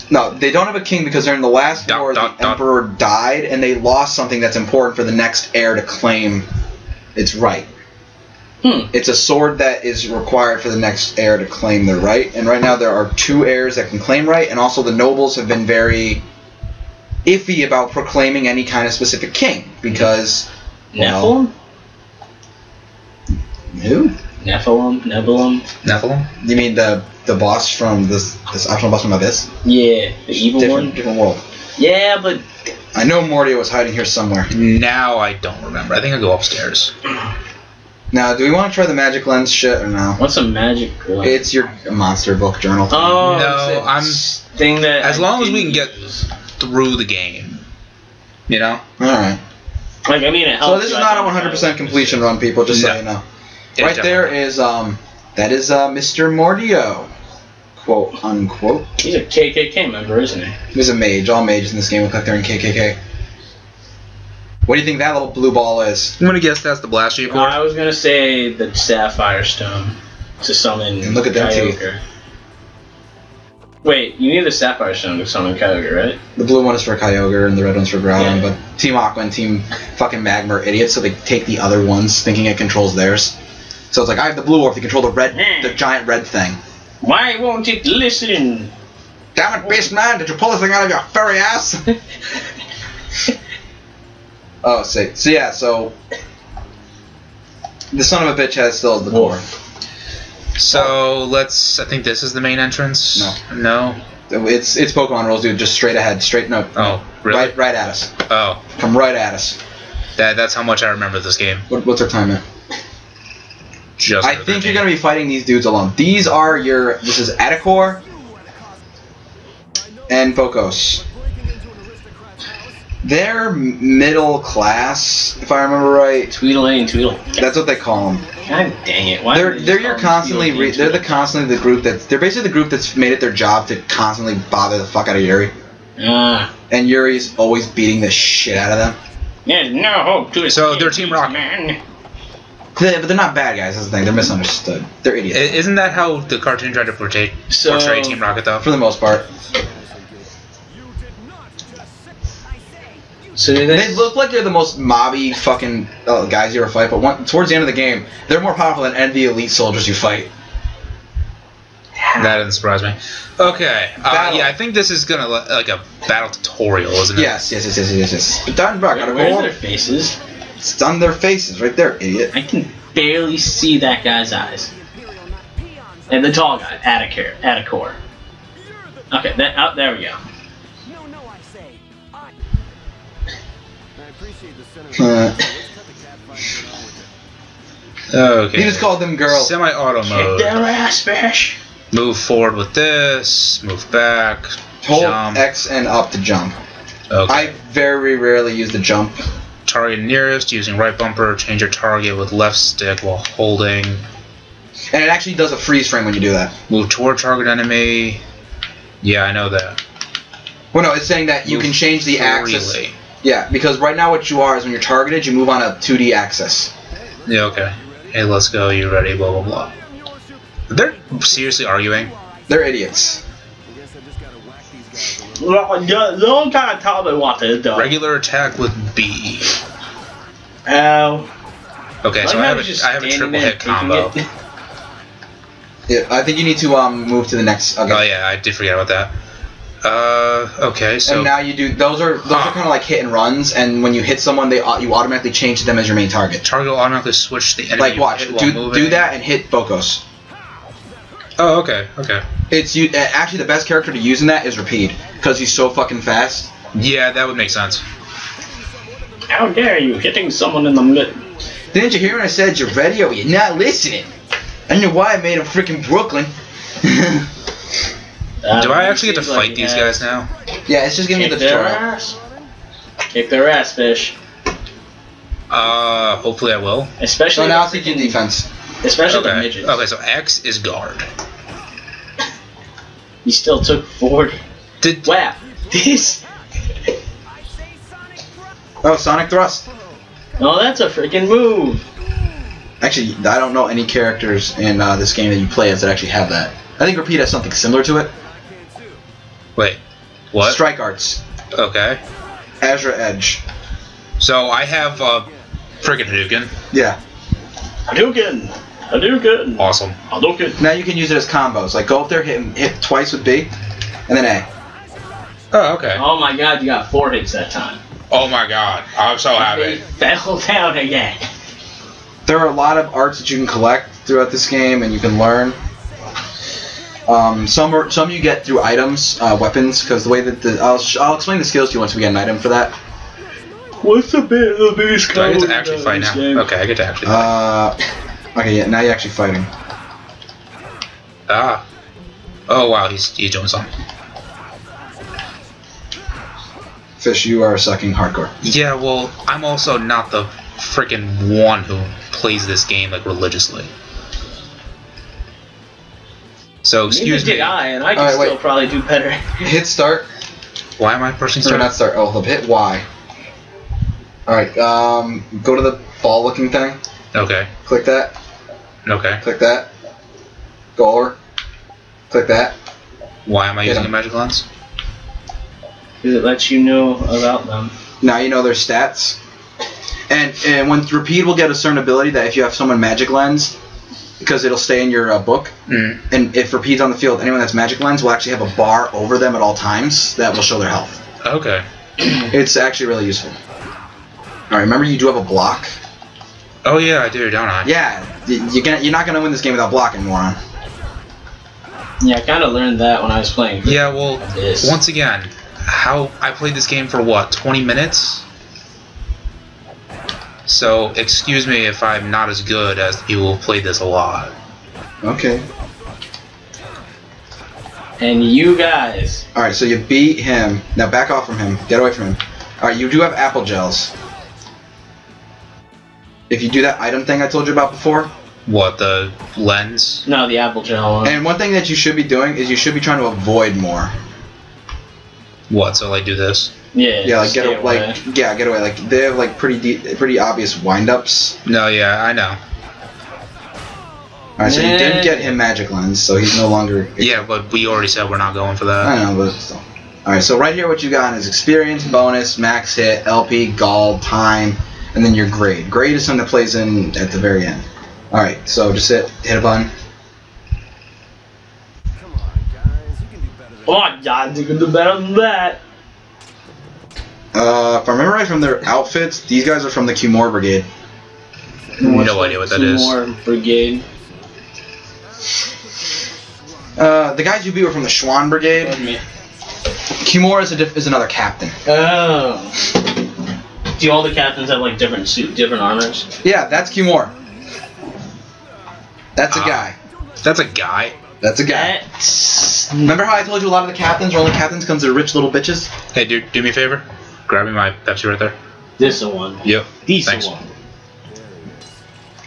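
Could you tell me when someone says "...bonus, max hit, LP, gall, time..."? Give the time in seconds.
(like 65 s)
451 s.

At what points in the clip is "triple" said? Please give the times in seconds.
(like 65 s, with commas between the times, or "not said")
233 s.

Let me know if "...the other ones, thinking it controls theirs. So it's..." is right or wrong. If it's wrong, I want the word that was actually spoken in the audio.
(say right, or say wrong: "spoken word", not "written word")
right.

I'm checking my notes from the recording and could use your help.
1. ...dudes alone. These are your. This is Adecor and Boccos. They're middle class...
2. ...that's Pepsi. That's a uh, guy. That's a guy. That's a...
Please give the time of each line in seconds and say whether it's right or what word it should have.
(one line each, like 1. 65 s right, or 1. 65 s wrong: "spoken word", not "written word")
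1. 115 s right
2. 486 s wrong: "Kimura", not "Pepsi".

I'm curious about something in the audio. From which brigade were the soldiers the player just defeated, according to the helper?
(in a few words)
Schwann Brigade.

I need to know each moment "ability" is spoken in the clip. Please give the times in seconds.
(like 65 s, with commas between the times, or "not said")
381 s.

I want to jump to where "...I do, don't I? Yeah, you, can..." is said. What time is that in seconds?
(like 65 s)
397 s.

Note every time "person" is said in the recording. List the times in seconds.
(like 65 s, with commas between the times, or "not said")
not said.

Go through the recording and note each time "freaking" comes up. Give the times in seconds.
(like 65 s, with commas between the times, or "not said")
265 s, 290 s, 350 s.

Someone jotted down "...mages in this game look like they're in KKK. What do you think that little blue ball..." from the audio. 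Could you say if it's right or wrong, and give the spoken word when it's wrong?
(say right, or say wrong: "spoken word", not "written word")
right.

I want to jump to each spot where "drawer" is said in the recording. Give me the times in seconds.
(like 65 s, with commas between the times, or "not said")
not said.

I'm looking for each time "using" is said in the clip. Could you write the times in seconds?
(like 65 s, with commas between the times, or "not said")
200 s, 373 s.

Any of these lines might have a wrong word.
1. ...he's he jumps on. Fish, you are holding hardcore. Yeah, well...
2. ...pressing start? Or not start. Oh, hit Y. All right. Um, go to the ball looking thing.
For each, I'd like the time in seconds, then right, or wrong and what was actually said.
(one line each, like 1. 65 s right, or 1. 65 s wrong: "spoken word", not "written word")
1. 342 s wrong: "sucking", not "holding"
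2. 361 s right.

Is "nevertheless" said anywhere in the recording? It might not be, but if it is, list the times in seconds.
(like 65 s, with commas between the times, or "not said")
not said.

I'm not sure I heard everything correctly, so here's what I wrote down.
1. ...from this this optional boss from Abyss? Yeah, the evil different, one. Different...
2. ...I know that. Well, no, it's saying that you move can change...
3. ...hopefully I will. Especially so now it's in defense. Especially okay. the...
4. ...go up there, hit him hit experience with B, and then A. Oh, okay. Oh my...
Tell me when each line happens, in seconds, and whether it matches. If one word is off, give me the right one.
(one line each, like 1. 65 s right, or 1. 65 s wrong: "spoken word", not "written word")
1. 27 s right
2. 209 s right
3. 276 s right
4. 311 s wrong: "twice", not "experience".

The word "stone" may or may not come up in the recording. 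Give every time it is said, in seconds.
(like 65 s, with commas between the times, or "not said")
69 s, 74 s.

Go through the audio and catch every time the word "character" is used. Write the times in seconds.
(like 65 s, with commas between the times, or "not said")
253 s, 293 s.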